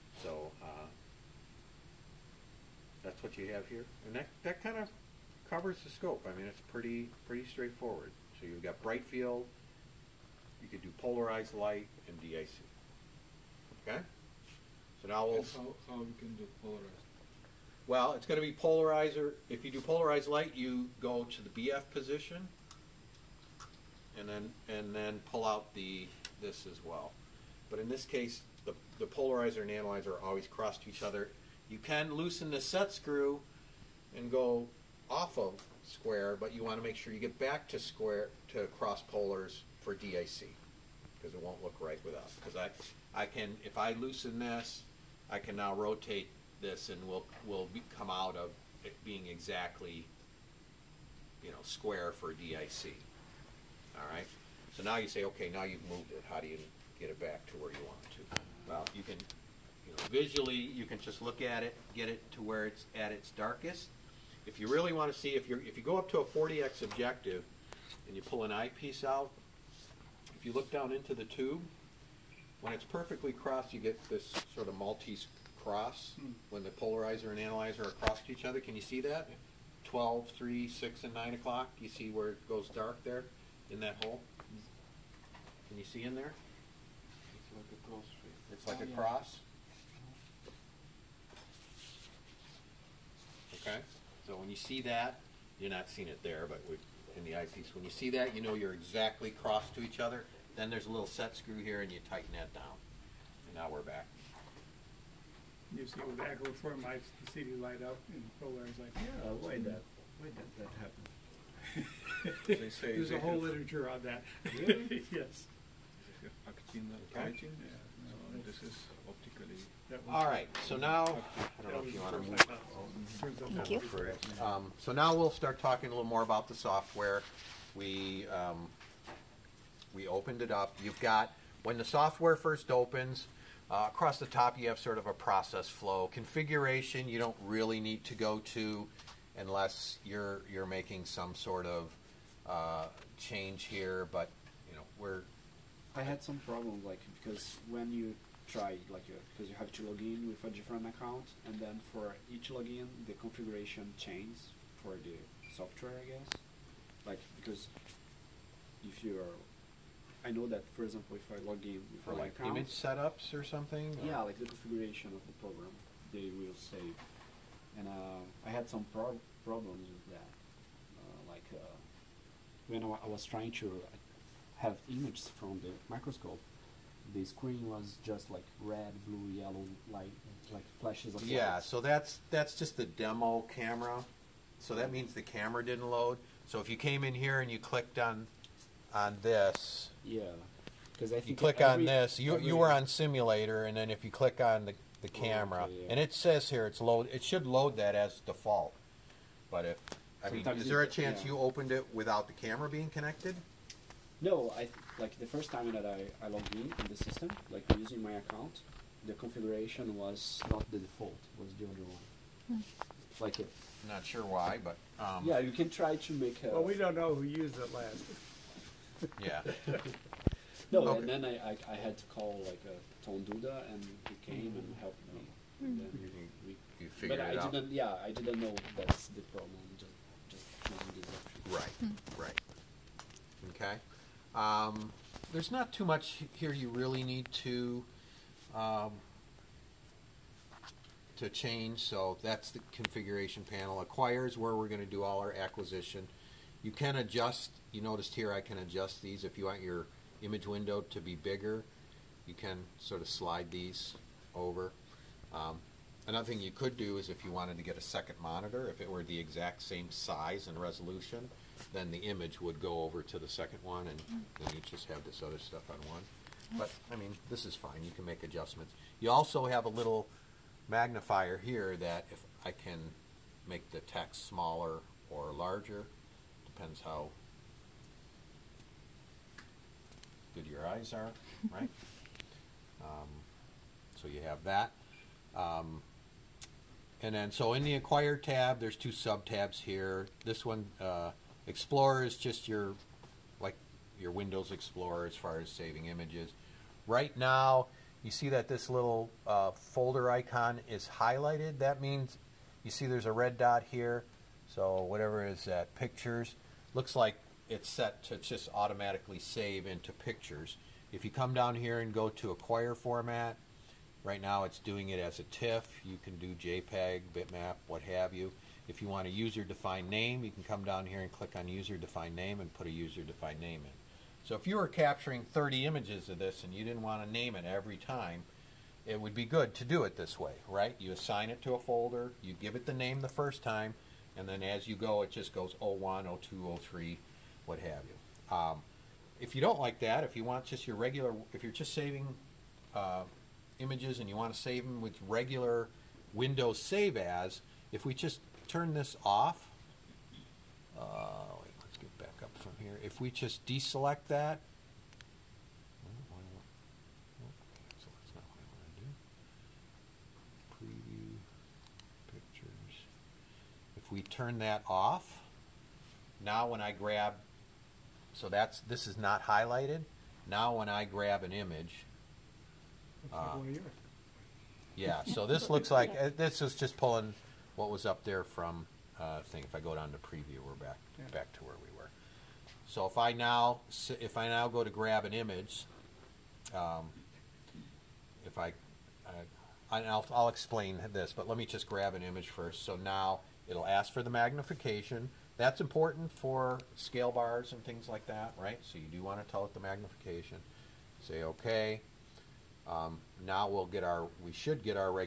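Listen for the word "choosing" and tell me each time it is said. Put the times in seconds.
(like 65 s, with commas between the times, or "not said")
230 s.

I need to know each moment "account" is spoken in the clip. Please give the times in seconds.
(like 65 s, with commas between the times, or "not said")
150 s, 162 s, 208 s.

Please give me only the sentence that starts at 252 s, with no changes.
You can sort of slide these over.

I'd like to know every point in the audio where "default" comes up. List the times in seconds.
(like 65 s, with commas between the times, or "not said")
198 s, 210 s.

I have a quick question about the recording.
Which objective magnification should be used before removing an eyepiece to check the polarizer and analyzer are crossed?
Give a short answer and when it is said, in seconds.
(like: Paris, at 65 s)
40x, at 66 s.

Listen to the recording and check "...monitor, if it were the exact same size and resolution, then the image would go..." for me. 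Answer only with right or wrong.
right.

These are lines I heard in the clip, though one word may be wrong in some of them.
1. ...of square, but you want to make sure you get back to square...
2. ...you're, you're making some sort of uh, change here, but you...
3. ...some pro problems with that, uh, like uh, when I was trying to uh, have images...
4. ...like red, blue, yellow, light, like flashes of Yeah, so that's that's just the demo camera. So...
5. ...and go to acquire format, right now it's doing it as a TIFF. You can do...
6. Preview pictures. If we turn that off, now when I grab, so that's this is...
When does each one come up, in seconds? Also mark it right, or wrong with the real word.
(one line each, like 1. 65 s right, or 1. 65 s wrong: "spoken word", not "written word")
1. 35 s right
2. 140 s right
3. 168 s right
4. 178 s right
5. 311 s right
6. 360 s right.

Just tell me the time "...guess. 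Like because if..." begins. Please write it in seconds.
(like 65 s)
156 s.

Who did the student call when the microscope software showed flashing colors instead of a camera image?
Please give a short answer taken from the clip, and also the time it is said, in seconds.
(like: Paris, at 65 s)
Tom Duda, at 223 s.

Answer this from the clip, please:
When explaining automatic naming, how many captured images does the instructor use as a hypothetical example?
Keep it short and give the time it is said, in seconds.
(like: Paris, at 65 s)
30, at 325 s.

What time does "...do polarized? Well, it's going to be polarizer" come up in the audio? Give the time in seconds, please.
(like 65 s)
16 s.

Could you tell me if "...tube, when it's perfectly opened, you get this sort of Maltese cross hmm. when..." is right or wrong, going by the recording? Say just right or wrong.
wrong.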